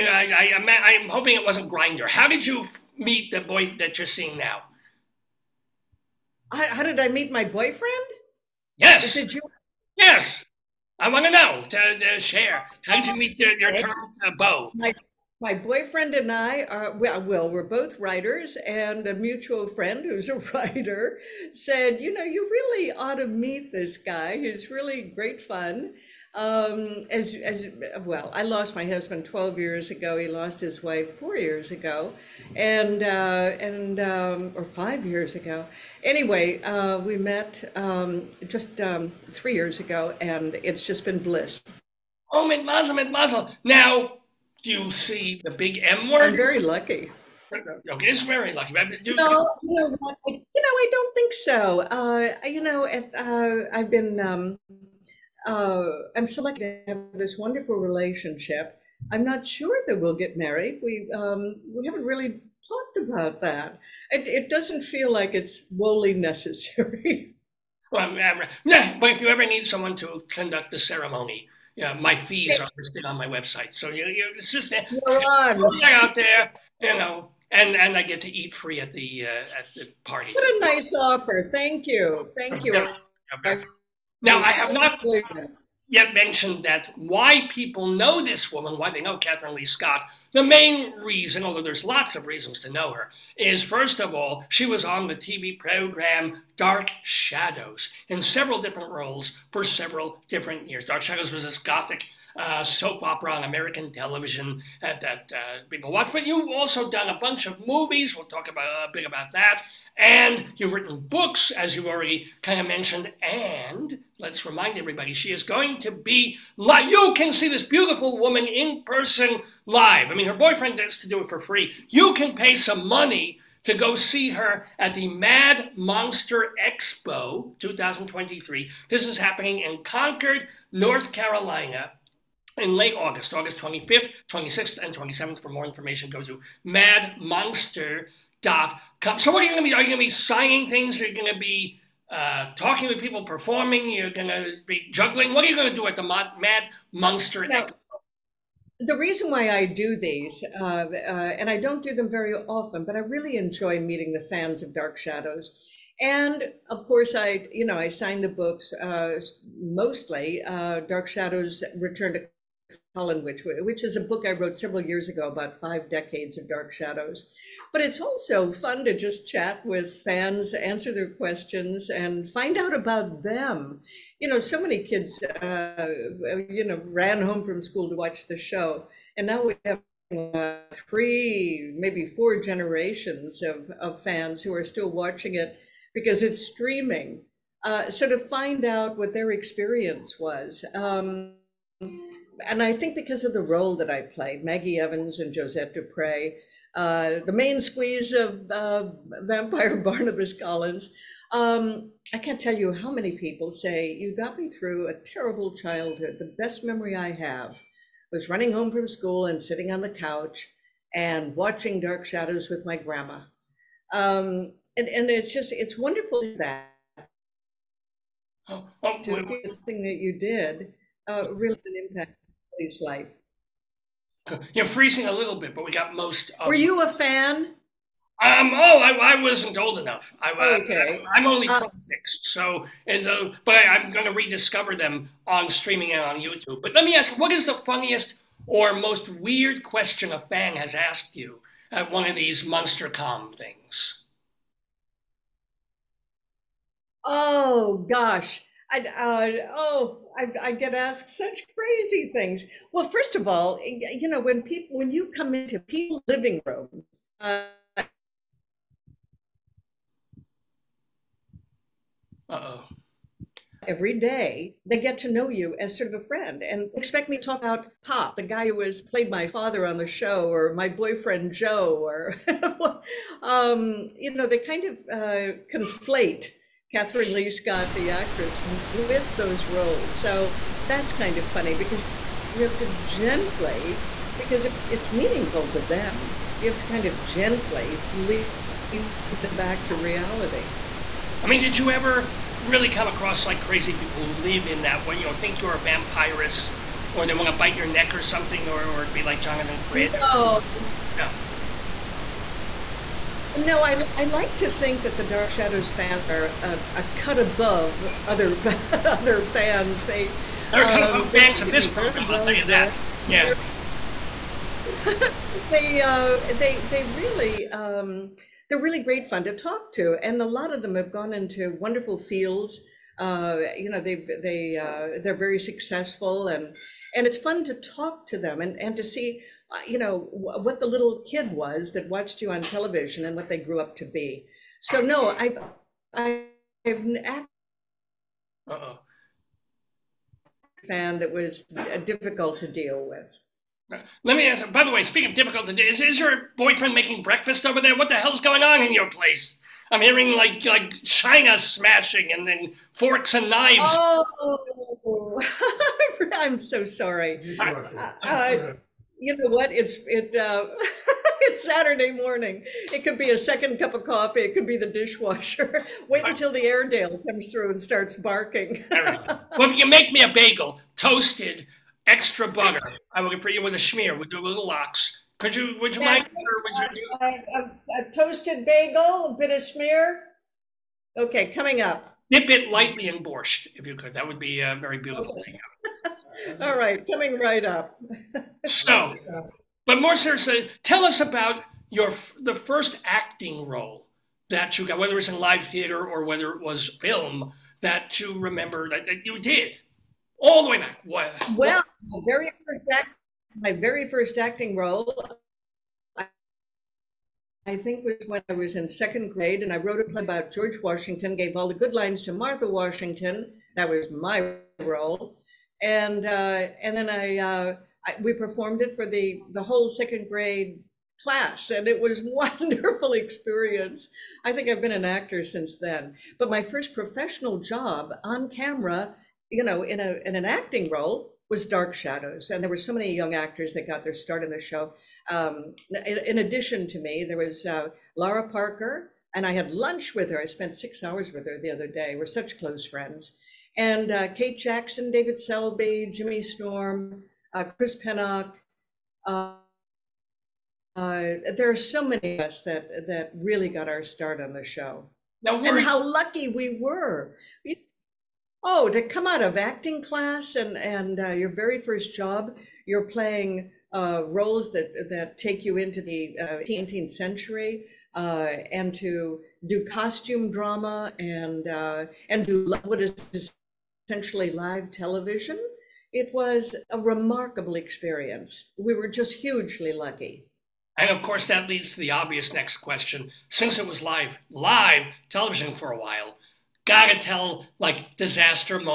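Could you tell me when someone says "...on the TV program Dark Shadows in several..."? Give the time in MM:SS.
01:34.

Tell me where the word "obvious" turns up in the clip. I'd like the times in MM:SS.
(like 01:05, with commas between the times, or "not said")
08:01.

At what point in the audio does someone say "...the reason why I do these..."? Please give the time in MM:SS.
02:28.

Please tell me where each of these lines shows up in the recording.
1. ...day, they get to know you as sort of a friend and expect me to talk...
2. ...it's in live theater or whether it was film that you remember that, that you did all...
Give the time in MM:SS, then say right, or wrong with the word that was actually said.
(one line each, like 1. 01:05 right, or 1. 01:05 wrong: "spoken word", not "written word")
1. 04:23 right
2. 06:34 right.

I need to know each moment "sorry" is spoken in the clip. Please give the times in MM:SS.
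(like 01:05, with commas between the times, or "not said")
05:56.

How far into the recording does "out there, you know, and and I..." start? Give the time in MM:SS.
01:15.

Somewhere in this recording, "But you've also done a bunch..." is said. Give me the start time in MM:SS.
01:46.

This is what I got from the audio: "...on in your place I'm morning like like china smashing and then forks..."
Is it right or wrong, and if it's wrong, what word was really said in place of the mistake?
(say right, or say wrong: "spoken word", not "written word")
wrong: "hearing", not "morning".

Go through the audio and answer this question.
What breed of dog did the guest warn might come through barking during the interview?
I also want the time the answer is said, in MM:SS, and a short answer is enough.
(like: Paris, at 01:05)
Airedale, at 06:06.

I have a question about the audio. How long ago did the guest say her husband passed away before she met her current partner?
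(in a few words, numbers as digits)
12 years.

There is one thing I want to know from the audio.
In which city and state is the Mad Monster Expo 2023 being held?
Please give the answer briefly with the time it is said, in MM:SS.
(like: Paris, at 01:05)
Concord, North Carolina, at 02:09.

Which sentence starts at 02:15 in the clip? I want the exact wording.
For more information, go to madmonster.com.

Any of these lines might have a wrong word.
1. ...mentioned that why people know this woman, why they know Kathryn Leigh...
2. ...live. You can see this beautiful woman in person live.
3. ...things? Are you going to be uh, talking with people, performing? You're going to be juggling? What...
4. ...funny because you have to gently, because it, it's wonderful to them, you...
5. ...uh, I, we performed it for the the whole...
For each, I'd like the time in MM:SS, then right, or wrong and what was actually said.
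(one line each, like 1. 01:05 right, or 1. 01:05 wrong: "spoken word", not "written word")
1. 01:26 right
2. 01:56 right
3. 02:20 right
4. 04:41 wrong: "meaningful", not "wonderful"
5. 06:57 right.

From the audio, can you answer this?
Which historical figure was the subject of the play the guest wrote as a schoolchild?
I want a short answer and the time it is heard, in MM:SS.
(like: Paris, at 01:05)
George Washington, at 06:50.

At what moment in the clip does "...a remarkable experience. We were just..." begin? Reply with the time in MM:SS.
07:56.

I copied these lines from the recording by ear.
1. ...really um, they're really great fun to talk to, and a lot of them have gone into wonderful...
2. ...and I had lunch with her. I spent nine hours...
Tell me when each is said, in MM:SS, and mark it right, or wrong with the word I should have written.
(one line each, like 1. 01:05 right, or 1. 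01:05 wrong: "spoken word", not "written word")
1. 05:16 right
2. 07:19 wrong: "six", not "nine".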